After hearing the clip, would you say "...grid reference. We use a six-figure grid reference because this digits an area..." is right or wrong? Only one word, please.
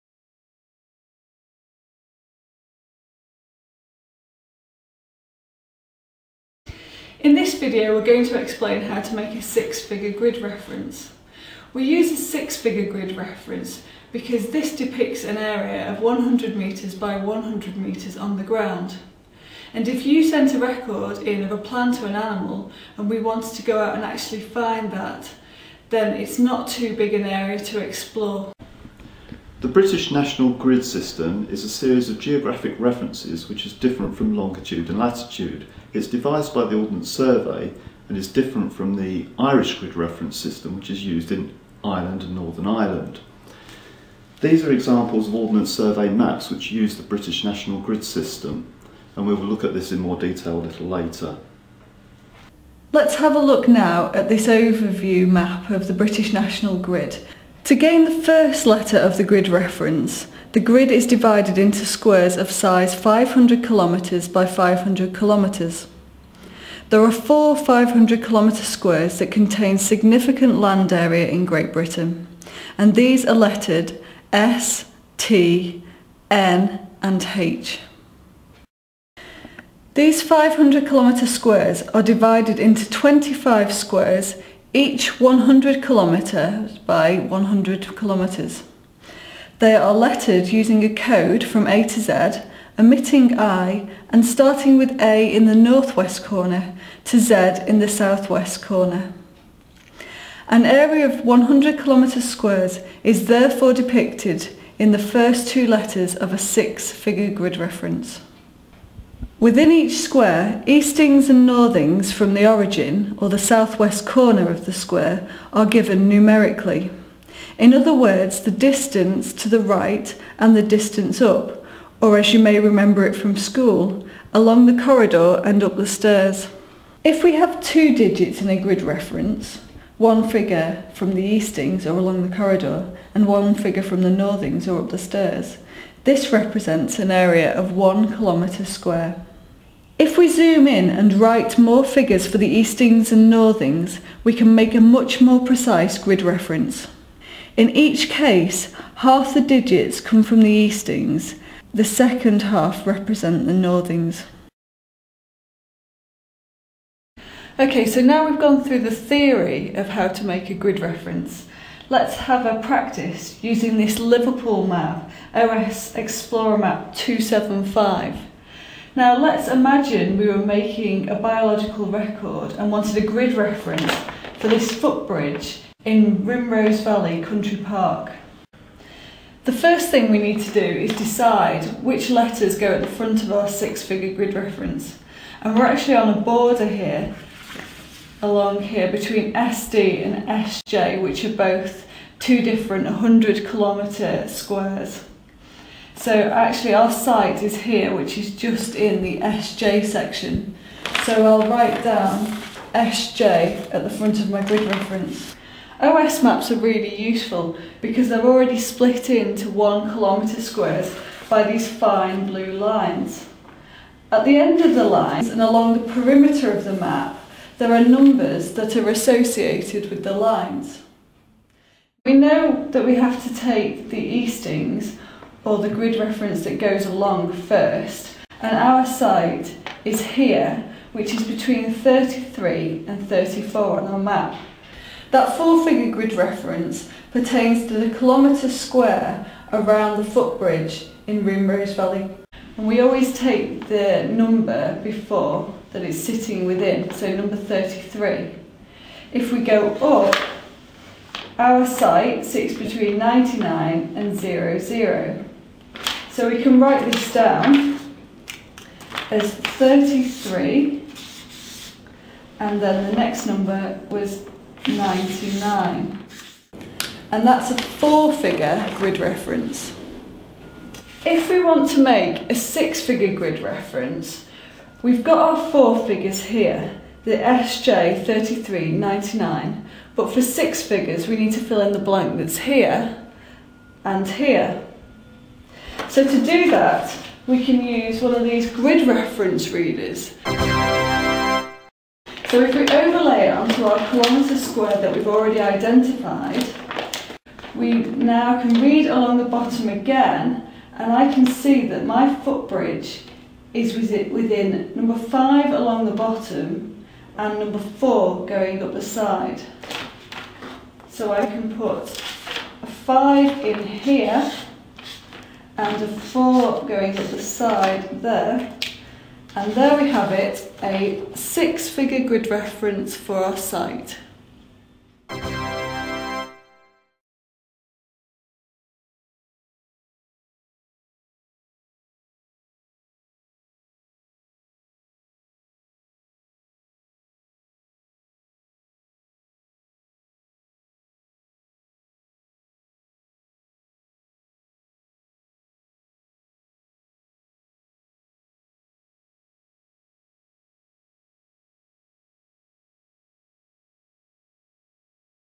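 wrong.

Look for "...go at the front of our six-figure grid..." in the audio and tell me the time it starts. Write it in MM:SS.
03:02.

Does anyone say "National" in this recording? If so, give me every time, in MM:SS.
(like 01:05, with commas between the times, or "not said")
00:30, 00:47, 00:56.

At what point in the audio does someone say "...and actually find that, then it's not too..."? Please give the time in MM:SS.
00:23.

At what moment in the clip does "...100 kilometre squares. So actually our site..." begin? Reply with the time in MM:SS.
03:12.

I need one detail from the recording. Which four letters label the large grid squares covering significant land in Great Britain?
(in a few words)
S, T, N and H.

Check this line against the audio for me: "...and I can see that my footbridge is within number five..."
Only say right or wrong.
right.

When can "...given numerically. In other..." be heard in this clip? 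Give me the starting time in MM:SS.
01:55.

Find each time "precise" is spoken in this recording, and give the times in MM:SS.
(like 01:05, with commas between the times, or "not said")
02:25.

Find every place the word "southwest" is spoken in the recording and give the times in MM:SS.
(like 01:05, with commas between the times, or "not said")
01:37, 01:53.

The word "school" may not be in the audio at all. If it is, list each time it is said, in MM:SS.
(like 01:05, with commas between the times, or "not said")
02:03.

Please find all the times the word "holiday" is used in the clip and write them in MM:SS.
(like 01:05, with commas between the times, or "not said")
not said.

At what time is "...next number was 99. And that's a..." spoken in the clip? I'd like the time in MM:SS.
04:22.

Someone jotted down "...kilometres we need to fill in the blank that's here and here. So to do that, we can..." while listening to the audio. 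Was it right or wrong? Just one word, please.
wrong.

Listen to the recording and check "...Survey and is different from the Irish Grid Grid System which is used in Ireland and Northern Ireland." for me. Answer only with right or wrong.
wrong.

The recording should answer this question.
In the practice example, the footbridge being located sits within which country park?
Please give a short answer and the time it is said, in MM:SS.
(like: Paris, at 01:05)
Rimrose Valley Country Park, at 02:56.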